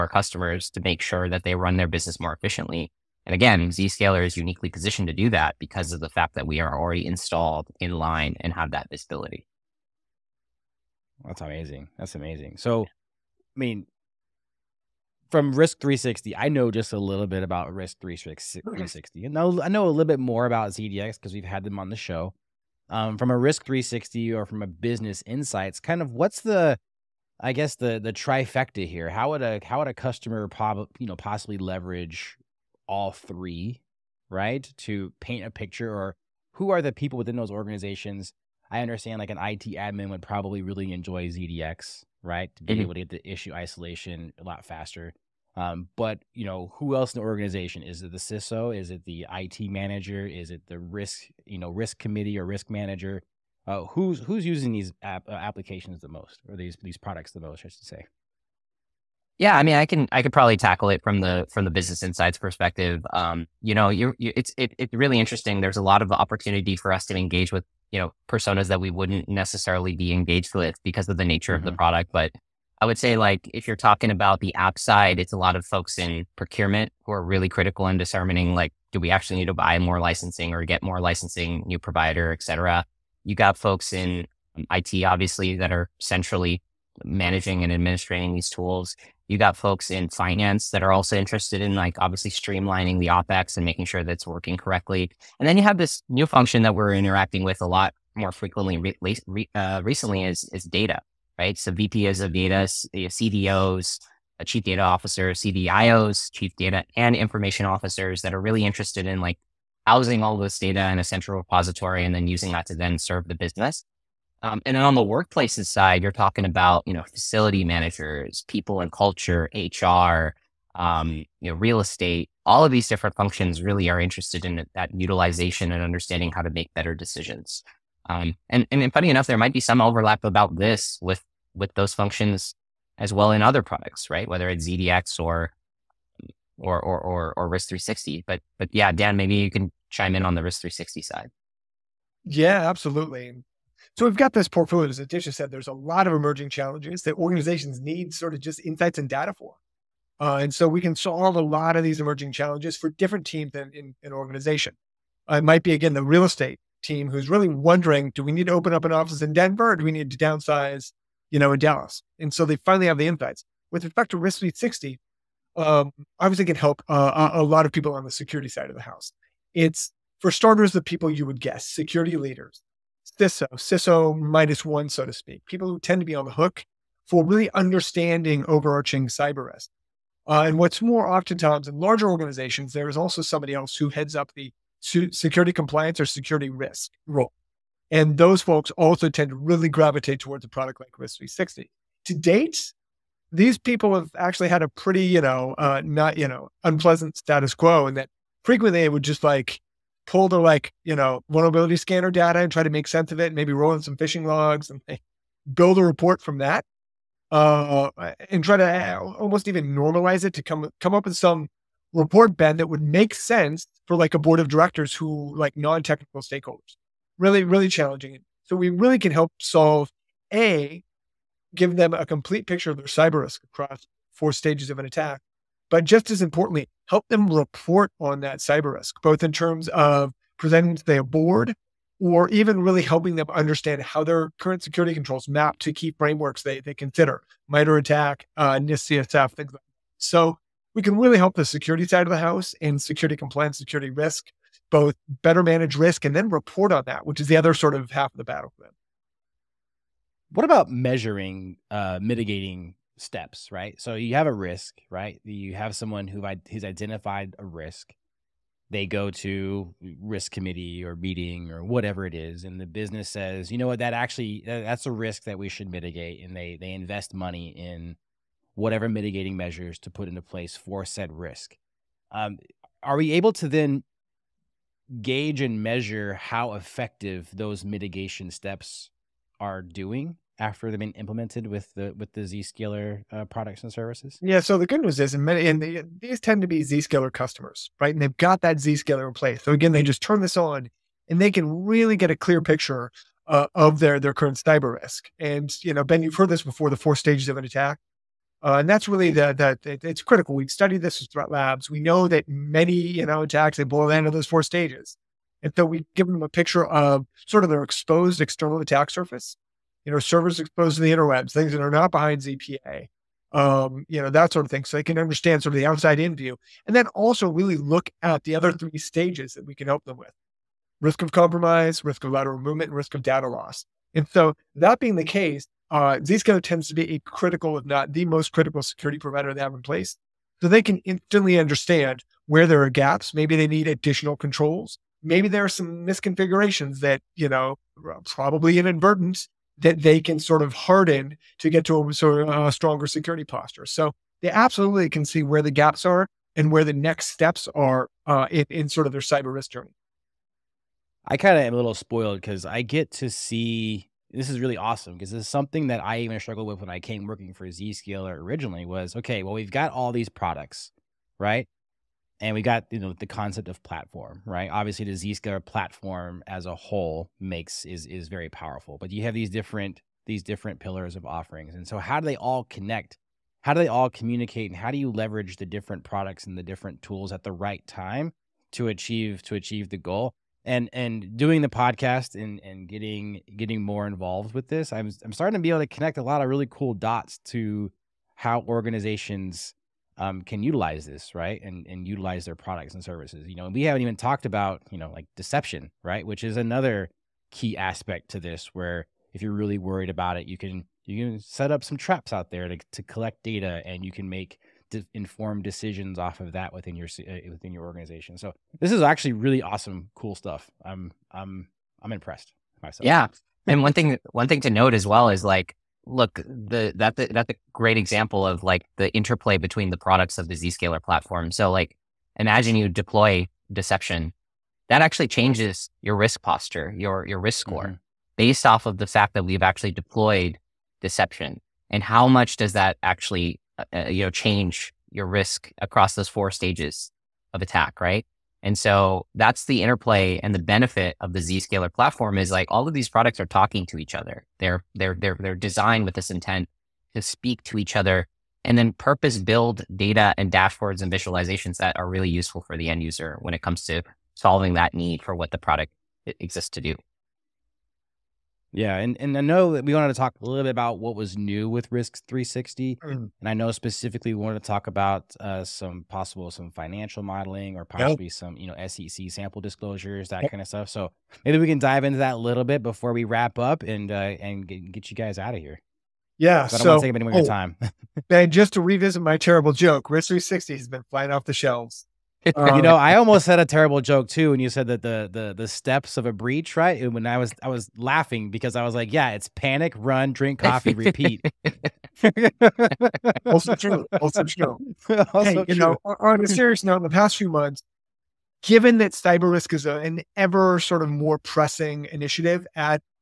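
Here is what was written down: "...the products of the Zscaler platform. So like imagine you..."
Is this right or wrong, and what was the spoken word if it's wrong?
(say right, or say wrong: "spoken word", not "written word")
right.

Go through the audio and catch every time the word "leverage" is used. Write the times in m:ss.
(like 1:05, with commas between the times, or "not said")
0:31, 6:14.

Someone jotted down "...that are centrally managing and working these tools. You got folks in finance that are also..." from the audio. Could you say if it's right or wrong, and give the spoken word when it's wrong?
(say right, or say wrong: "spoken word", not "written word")
wrong: "administrating", not "working".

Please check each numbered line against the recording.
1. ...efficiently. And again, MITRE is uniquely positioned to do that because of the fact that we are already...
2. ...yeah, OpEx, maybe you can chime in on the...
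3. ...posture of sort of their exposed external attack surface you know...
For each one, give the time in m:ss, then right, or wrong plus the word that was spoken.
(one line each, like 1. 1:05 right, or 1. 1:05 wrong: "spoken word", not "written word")
1. 0:02 wrong: "Zscaler", not "MITRE"
2. 2:18 wrong: "Dan", not "OpEx"
3. 5:06 wrong: "picture", not "posture".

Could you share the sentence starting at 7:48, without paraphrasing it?
some you know SEC sample disclosures that yep.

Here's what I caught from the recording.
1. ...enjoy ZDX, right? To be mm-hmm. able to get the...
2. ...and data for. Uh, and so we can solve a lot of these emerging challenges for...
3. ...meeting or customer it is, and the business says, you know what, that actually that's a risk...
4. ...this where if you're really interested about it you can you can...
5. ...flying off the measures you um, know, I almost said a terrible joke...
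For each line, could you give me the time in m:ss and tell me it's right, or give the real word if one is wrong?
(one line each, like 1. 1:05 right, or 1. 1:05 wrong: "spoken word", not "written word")
1. 0:40 right
2. 2:28 right
3. 4:20 wrong: "whatever", not "customer"
4. 6:38 wrong: "worried", not "interested"
5. 8:00 wrong: "shelves", not "measures".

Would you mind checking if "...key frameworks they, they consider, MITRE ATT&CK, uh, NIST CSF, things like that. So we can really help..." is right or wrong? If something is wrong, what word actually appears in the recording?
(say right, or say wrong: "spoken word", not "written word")
right.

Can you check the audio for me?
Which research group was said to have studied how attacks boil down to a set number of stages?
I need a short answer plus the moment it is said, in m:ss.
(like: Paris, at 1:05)
Threat labs, at 5:01.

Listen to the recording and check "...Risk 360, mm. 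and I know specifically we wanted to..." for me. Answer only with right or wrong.
right.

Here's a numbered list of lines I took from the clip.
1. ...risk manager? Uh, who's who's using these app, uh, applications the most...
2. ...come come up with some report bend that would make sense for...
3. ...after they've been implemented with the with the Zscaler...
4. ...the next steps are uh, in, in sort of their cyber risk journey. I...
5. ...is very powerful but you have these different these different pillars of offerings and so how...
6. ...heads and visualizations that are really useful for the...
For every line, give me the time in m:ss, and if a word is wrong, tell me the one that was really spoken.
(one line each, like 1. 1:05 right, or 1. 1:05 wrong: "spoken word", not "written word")
1. 0:52 right
2. 3:30 right
3. 4:40 right
4. 5:46 right
5. 6:07 right
6. 7:30 wrong: "dashboards", not "heads".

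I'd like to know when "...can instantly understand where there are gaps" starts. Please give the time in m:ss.
5:30.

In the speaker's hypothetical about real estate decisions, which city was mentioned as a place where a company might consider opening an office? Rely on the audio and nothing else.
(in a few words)
Denver.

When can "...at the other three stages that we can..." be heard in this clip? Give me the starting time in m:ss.
5:18.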